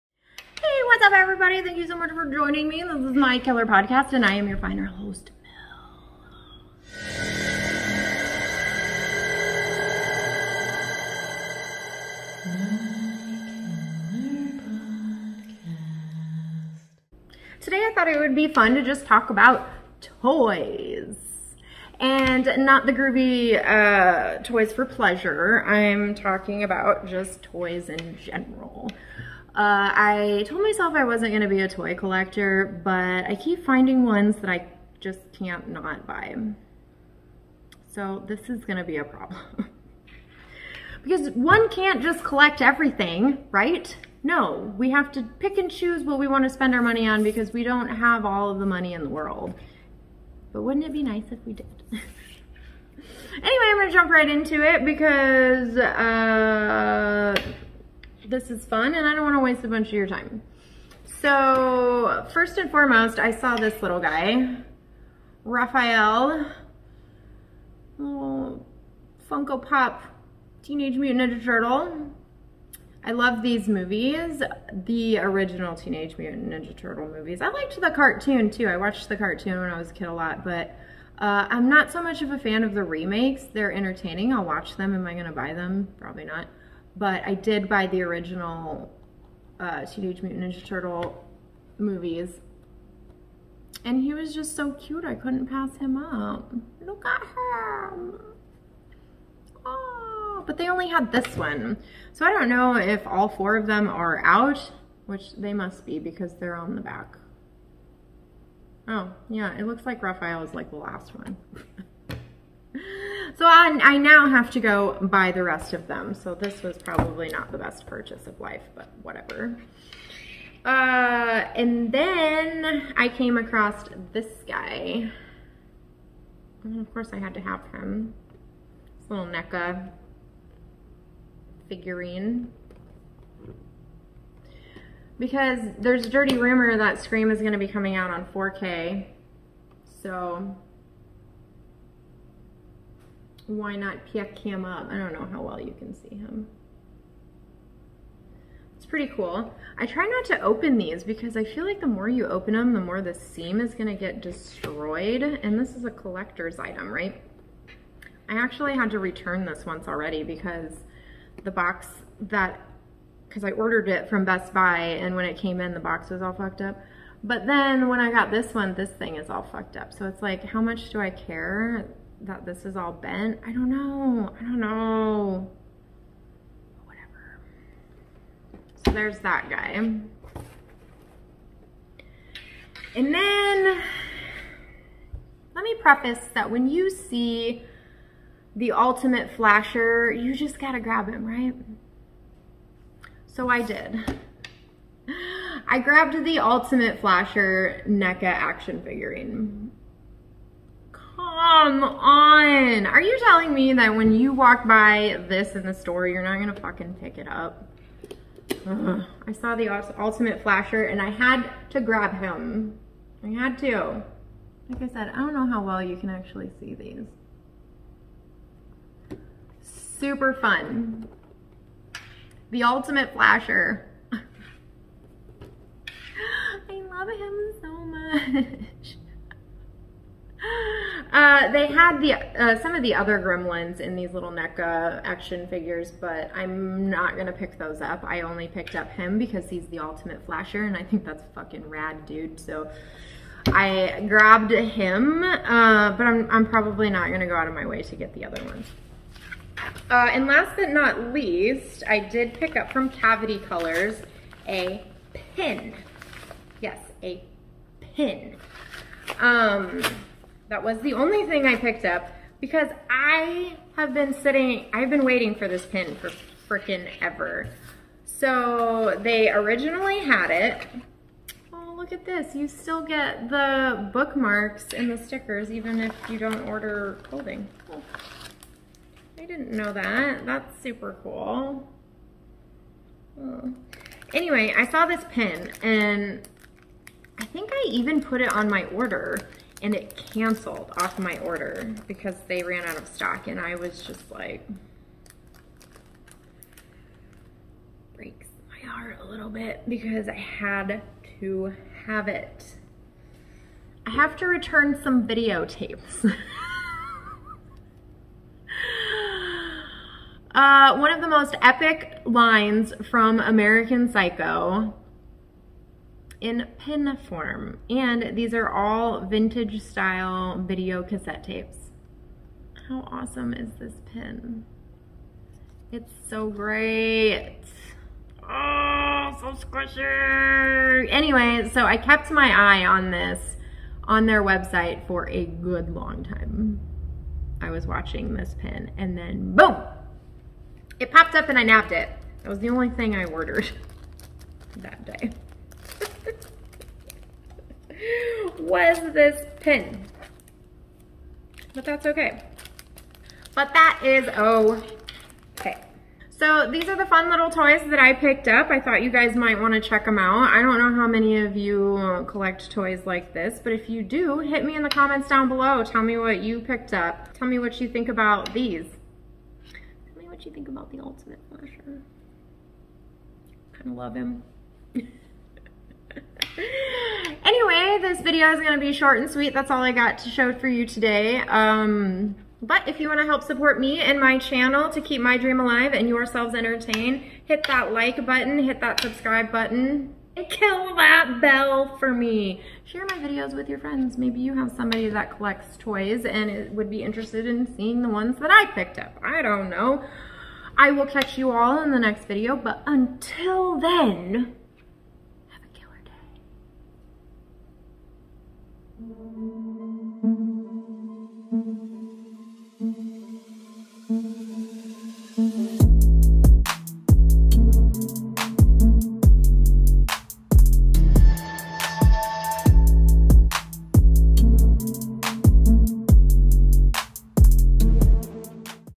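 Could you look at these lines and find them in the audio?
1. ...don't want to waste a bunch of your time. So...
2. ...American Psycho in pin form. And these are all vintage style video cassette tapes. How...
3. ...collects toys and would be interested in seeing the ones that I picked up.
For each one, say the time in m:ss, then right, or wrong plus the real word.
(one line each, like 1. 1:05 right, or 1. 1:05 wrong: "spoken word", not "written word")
1. 0:59 right
2. 5:13 right
3. 6:35 right.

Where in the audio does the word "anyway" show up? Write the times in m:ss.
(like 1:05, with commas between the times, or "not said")
0:51, 4:44, 5:30.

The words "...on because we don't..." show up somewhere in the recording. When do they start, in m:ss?
0:47.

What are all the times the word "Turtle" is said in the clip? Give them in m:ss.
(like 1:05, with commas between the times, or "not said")
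1:11, 1:16, 1:30.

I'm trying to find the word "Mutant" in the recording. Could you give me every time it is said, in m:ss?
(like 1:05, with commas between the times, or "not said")
1:10, 1:16, 1:30.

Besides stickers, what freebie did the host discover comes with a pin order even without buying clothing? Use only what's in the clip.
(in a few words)
bookmarks.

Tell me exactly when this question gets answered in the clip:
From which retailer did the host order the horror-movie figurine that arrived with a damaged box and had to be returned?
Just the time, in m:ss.
2:44.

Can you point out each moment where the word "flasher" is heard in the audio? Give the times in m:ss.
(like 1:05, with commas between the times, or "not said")
3:09, 3:16, 3:30, 3:43, 4:00, 6:11.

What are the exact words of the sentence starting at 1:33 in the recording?
And he was just so cute, I couldn't pass him up.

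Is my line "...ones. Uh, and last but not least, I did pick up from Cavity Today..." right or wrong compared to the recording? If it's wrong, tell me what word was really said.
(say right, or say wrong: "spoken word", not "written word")
wrong: "Colors", not "Today".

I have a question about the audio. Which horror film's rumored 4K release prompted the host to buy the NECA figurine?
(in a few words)
Scream.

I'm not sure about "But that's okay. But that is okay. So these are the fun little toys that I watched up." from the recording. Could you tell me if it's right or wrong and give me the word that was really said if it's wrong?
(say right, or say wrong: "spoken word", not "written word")
wrong: "picked", not "watched".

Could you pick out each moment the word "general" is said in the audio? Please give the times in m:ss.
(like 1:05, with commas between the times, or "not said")
0:28.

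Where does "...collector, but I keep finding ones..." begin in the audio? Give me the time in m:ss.
0:31.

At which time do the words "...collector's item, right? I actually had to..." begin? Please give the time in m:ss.
2:35.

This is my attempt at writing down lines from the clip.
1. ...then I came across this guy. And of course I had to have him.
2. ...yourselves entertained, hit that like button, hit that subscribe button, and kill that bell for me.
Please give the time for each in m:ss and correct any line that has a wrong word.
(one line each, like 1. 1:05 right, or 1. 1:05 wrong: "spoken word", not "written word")
1. 2:01 right
2. 6:25 right.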